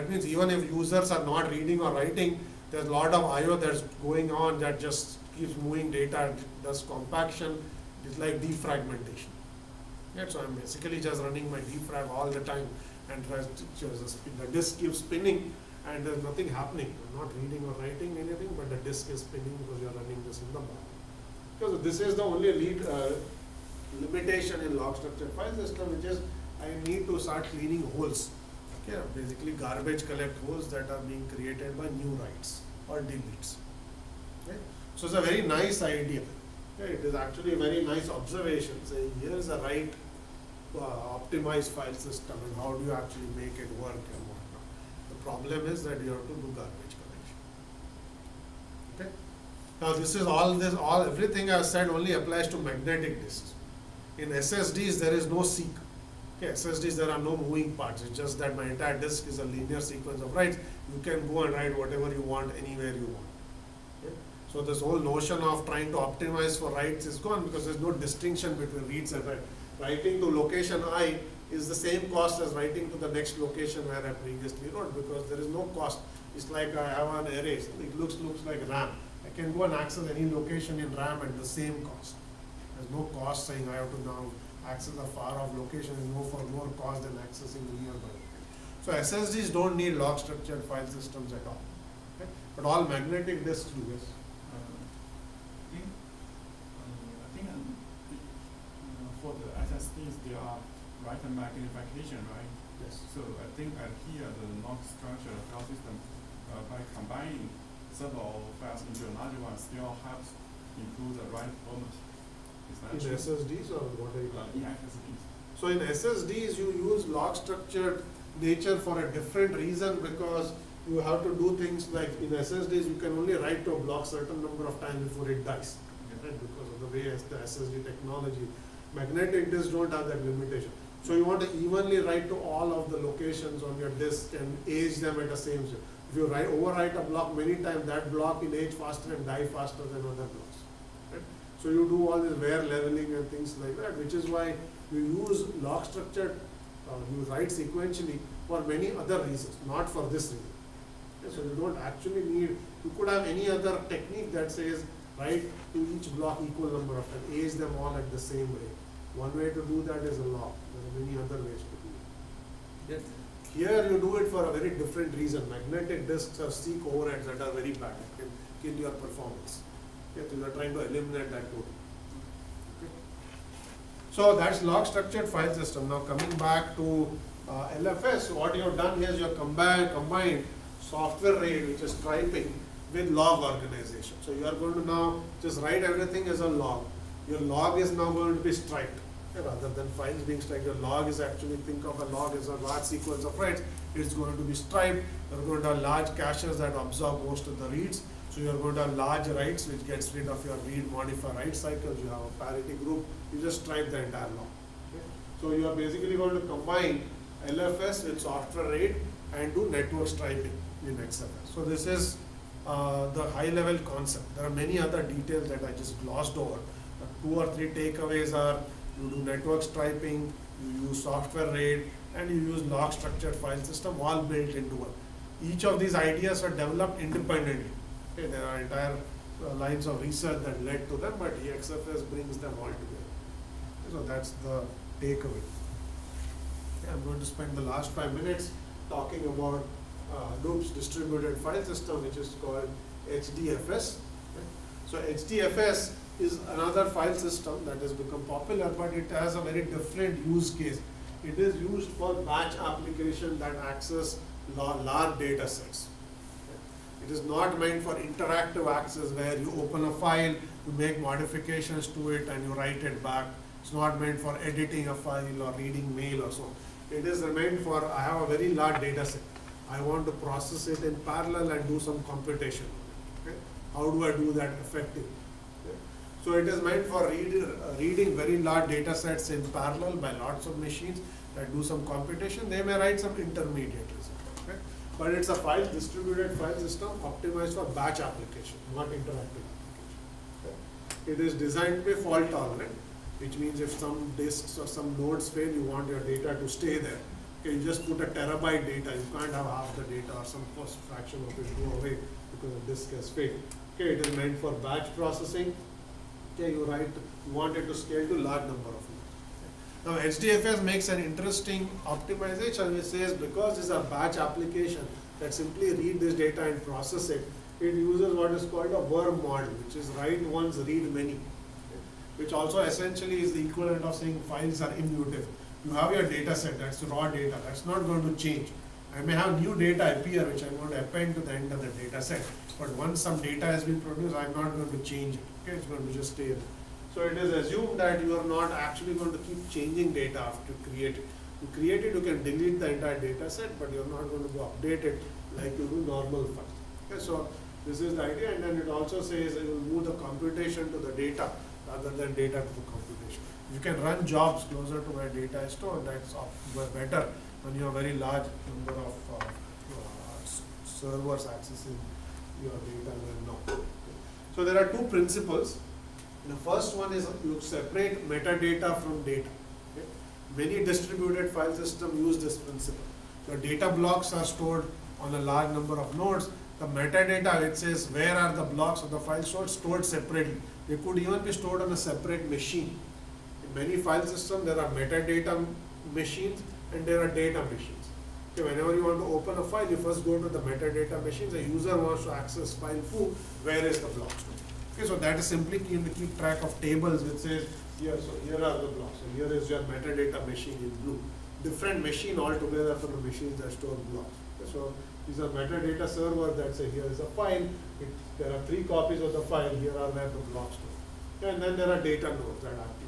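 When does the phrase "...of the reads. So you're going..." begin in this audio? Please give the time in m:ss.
3:17.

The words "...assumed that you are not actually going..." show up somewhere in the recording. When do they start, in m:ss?
5:37.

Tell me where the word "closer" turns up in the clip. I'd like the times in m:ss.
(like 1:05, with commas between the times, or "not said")
5:54.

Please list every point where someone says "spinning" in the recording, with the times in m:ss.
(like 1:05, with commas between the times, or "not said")
0:14, 0:19.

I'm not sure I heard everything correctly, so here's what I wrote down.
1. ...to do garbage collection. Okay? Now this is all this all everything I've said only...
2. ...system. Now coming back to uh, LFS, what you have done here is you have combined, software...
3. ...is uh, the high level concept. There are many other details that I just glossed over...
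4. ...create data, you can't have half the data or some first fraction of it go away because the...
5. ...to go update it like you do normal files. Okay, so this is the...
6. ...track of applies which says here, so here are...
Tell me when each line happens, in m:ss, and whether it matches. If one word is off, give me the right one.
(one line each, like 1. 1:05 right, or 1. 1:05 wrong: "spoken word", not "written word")
1. 0:46 right
2. 2:55 right
3. 3:31 right
4. 4:58 wrong: "terabyte", not "create"
5. 5:44 right
6. 6:36 wrong: "tables", not "applies".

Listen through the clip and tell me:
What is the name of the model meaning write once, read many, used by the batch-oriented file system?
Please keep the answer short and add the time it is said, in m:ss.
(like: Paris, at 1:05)
worm model, at 5:18.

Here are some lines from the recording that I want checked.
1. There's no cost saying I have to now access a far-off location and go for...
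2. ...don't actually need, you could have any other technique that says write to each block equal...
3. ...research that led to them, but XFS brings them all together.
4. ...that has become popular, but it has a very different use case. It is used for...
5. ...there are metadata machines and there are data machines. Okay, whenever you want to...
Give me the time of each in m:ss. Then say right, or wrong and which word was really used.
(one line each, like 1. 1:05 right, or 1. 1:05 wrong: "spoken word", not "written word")
1. 1:22 right
2. 2:31 right
3. 3:50 right
4. 4:07 right
5. 6:24 right.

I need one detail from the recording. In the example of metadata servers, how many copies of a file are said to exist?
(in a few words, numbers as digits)
3.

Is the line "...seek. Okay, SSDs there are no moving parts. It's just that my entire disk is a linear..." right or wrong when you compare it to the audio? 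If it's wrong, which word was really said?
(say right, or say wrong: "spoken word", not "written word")
right.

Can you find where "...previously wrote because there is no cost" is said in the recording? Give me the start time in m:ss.
1:14.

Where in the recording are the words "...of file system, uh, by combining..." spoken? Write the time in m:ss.
1:45.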